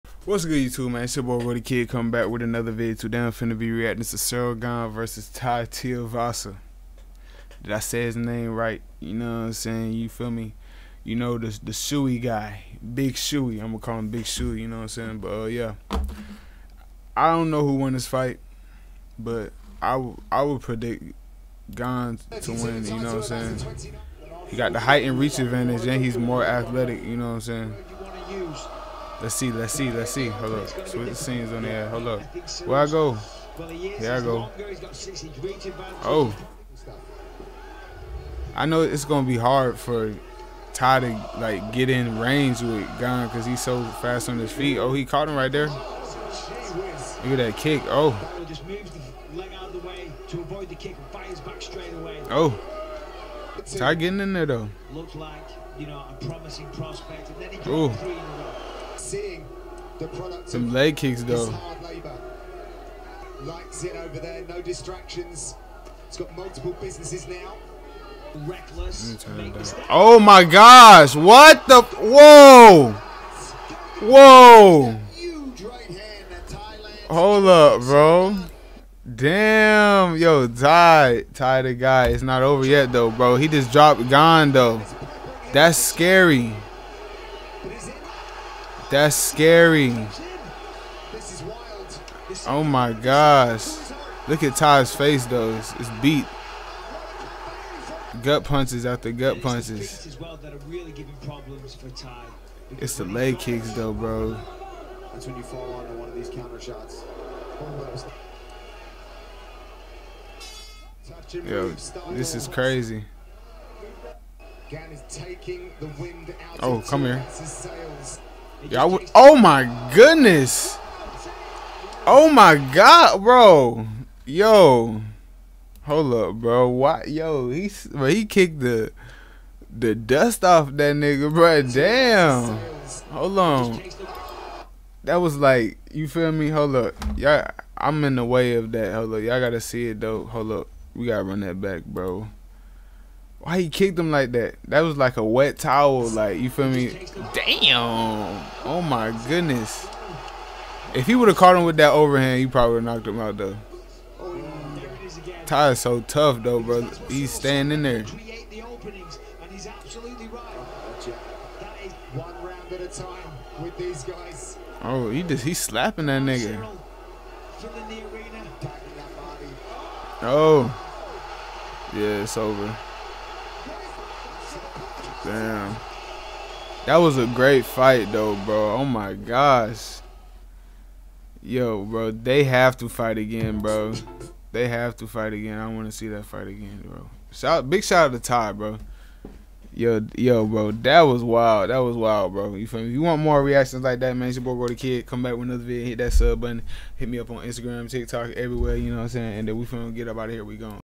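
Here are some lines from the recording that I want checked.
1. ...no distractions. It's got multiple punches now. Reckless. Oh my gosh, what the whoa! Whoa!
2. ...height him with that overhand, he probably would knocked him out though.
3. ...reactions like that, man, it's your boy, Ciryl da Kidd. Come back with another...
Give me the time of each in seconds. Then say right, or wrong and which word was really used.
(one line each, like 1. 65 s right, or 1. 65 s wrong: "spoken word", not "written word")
1. 64 s wrong: "businesses", not "punches"
2. 151 s wrong: "caught", not "height"
3. 193 s wrong: "Gloh", not "Ciryl".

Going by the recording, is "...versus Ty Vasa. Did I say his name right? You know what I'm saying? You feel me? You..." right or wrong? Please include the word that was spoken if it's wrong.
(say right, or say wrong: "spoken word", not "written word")
right.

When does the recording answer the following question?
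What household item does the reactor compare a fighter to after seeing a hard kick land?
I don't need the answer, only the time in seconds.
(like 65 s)
145 s.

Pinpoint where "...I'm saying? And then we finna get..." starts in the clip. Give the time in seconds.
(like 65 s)
199 s.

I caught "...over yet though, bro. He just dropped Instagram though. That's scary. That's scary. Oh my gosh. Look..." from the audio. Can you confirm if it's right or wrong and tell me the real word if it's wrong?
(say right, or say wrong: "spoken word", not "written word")
wrong: "Gane", not "Instagram".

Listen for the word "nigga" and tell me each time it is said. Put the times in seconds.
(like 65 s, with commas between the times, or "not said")
130 s, 166 s.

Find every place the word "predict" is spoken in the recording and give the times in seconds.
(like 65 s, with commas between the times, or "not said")
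20 s.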